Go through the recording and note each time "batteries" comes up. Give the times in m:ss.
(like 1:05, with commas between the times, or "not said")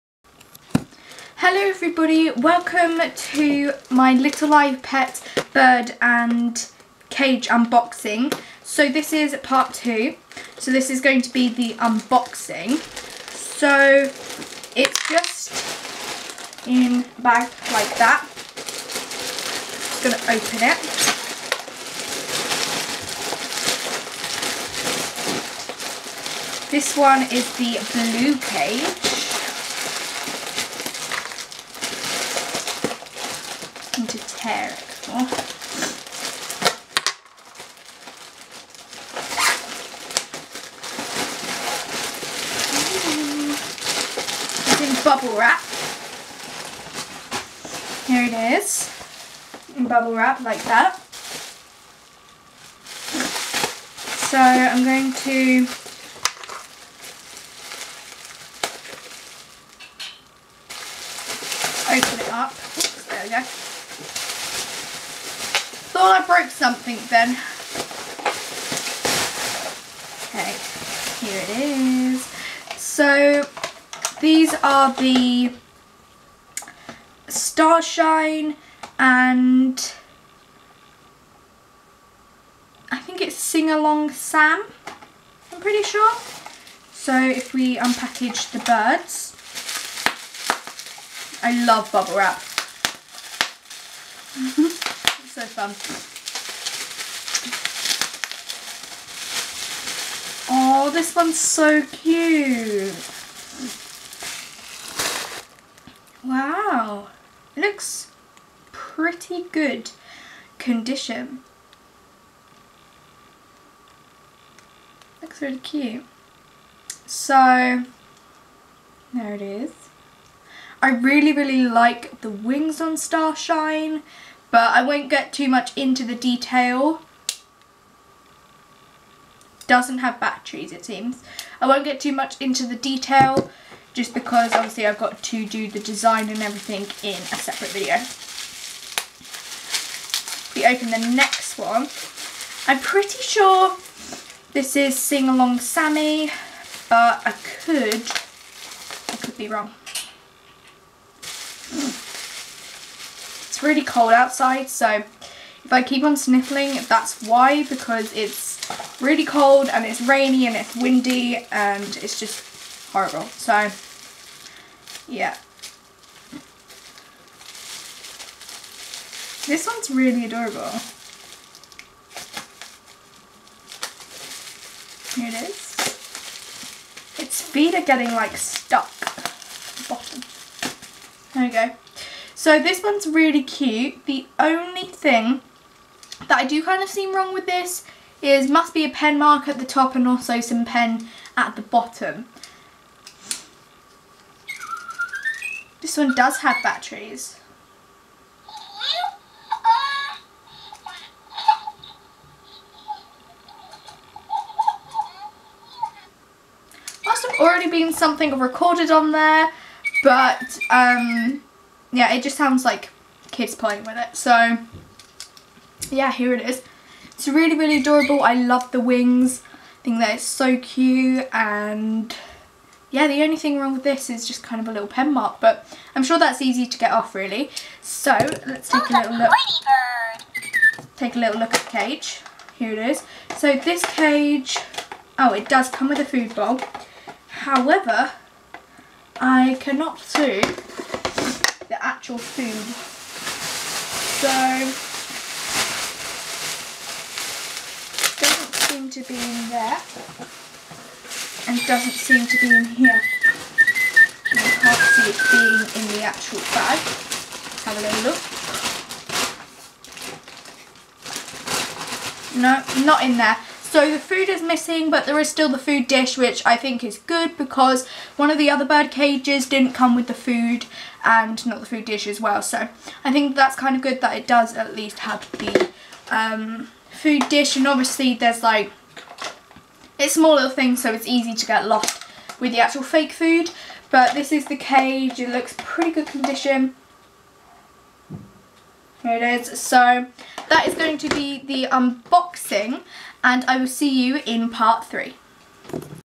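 2:10, 3:16.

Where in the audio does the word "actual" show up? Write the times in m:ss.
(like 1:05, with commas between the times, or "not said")
4:02, 4:16, 4:42.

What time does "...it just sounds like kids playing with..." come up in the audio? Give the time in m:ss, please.
3:32.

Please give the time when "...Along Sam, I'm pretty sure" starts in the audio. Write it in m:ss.
1:23.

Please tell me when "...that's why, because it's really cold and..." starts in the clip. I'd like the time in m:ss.
2:36.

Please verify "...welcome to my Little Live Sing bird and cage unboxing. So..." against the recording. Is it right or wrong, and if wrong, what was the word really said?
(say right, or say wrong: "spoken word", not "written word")
wrong: "Pet", not "Sing".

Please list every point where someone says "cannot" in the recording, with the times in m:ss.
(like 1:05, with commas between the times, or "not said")
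3:59.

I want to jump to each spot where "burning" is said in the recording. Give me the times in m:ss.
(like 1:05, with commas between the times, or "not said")
not said.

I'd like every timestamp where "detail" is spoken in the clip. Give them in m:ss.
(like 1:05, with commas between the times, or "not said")
2:06, 2:12.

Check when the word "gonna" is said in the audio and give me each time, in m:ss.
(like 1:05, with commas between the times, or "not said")
0:20.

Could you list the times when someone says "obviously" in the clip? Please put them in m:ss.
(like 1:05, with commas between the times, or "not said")
2:14, 4:37.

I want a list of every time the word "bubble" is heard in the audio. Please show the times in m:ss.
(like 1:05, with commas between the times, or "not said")
0:45, 0:49, 1:31.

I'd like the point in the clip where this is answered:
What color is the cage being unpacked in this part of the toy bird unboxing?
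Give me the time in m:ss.
0:27.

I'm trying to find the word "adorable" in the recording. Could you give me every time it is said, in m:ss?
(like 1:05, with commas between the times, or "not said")
2:50, 3:37.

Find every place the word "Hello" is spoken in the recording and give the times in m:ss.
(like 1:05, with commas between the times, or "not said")
0:01.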